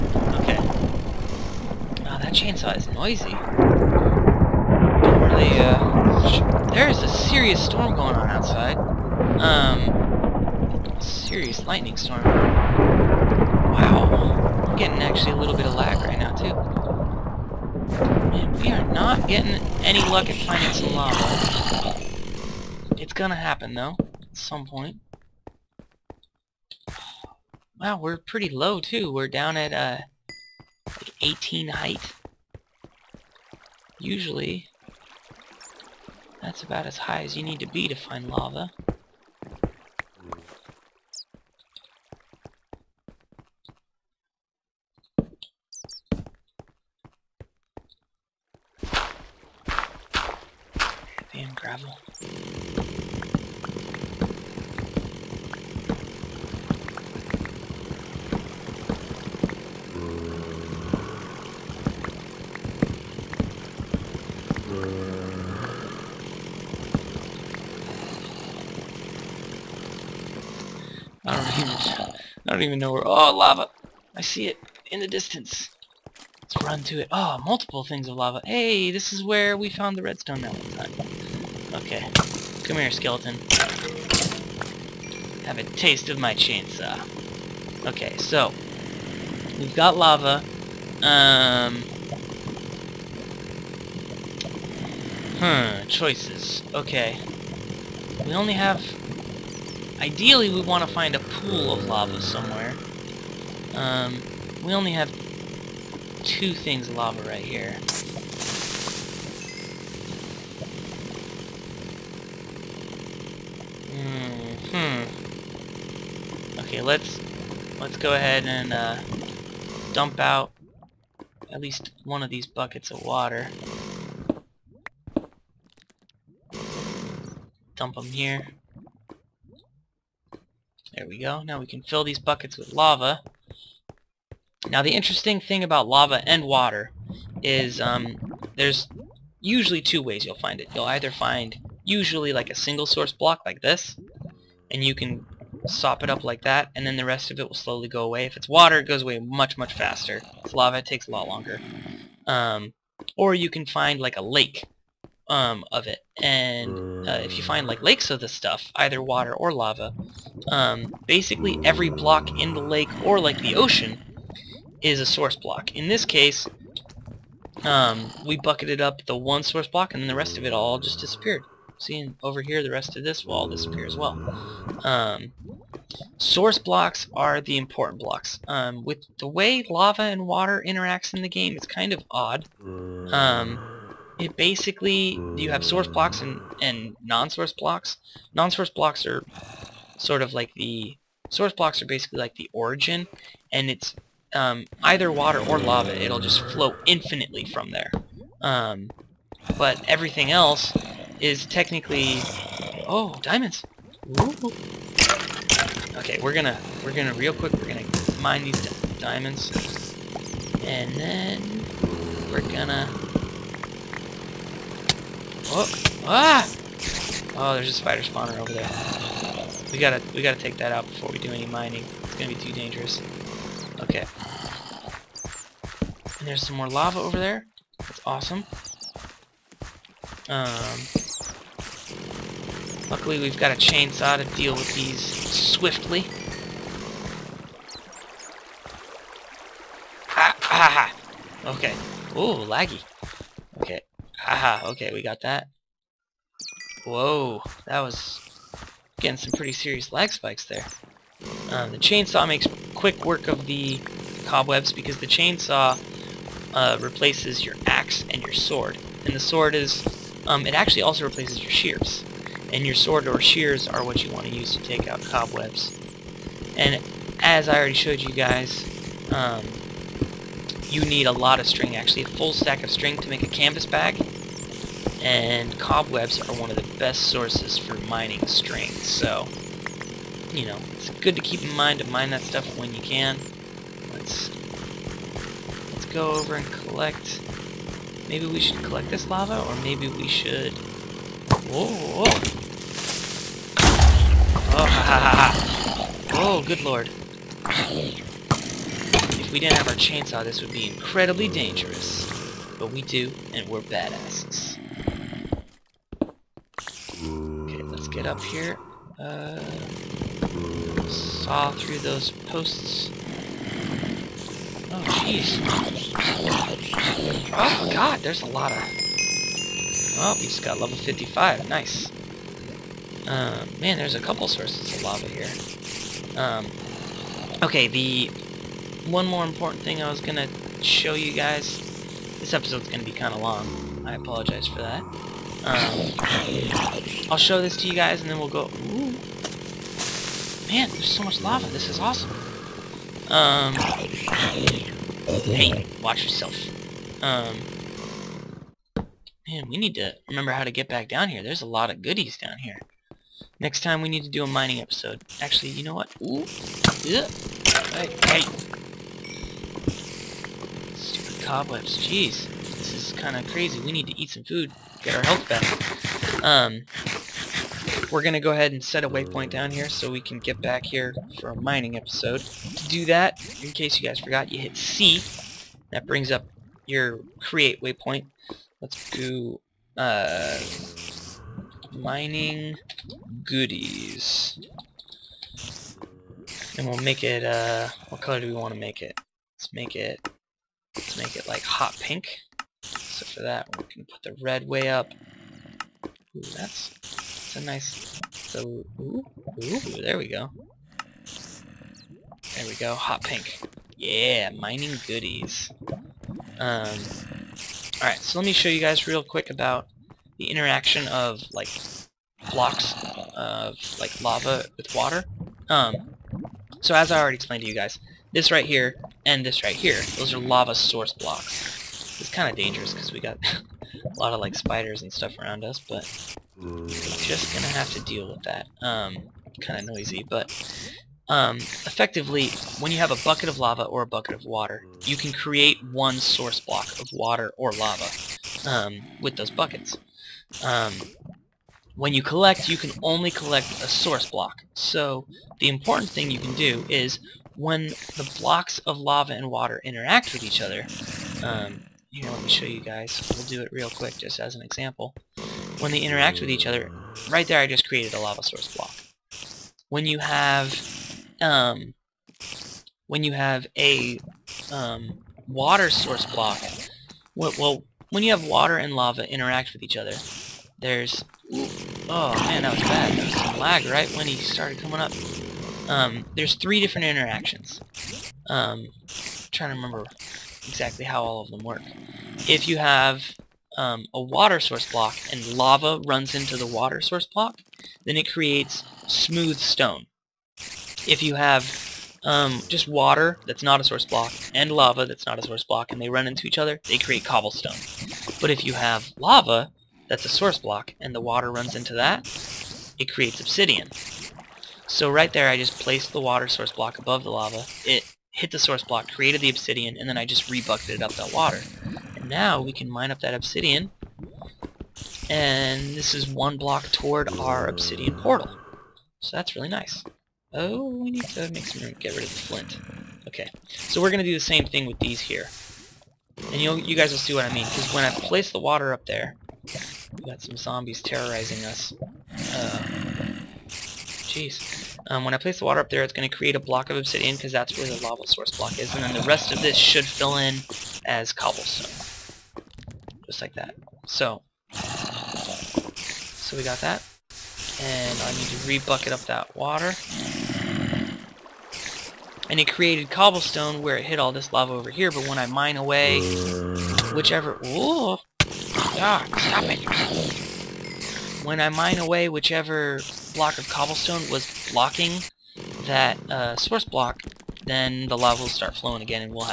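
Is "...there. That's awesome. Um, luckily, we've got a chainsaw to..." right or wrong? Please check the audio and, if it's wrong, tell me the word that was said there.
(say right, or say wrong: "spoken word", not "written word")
right.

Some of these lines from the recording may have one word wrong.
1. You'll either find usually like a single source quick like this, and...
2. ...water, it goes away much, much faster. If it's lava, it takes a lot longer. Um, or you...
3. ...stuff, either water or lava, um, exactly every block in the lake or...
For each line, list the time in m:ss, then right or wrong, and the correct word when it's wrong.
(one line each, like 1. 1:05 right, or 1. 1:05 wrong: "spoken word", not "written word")
1. 2:20 wrong: "block", not "quick"
2. 2:28 right
3. 2:38 wrong: "basically", not "exactly".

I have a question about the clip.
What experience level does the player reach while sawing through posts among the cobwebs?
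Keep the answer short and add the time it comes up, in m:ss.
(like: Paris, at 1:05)
55, at 5:20.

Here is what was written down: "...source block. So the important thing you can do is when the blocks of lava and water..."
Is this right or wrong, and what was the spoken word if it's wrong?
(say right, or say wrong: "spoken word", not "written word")
right.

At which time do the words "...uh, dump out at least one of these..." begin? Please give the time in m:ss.
1:58.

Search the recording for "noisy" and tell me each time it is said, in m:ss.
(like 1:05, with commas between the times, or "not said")
0:02, 7:09.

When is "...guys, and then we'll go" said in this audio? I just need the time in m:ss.
5:37.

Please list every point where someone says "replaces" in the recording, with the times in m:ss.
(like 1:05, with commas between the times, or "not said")
4:16, 4:21.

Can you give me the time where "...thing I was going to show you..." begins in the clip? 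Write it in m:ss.
5:29.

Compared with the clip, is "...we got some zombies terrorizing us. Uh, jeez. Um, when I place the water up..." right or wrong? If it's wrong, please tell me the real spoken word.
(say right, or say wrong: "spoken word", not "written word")
right.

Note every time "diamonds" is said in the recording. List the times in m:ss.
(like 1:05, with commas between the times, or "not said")
3:23, 3:28.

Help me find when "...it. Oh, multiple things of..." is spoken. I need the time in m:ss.
1:17.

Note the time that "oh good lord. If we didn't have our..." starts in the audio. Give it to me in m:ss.
4:56.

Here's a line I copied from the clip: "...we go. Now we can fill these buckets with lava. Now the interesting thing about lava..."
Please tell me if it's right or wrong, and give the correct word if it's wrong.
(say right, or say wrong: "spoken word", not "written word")
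right.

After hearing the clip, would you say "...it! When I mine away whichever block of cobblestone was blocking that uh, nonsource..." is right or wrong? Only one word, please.
wrong.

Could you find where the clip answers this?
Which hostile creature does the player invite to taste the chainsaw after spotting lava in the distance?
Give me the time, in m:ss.
1:22.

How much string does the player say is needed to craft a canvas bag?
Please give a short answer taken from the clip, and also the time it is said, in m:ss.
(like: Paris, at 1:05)
a full stack, at 4:32.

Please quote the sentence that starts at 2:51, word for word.
Seeing over here, the rest of this will all disappear as well.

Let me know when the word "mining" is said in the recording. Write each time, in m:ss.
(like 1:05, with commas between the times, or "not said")
3:41, 4:37, 5:54, 6:11, 6:21, 6:44.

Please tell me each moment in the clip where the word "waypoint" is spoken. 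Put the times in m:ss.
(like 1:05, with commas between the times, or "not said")
6:08, 6:17.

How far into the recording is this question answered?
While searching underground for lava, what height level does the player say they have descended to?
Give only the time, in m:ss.
0:31.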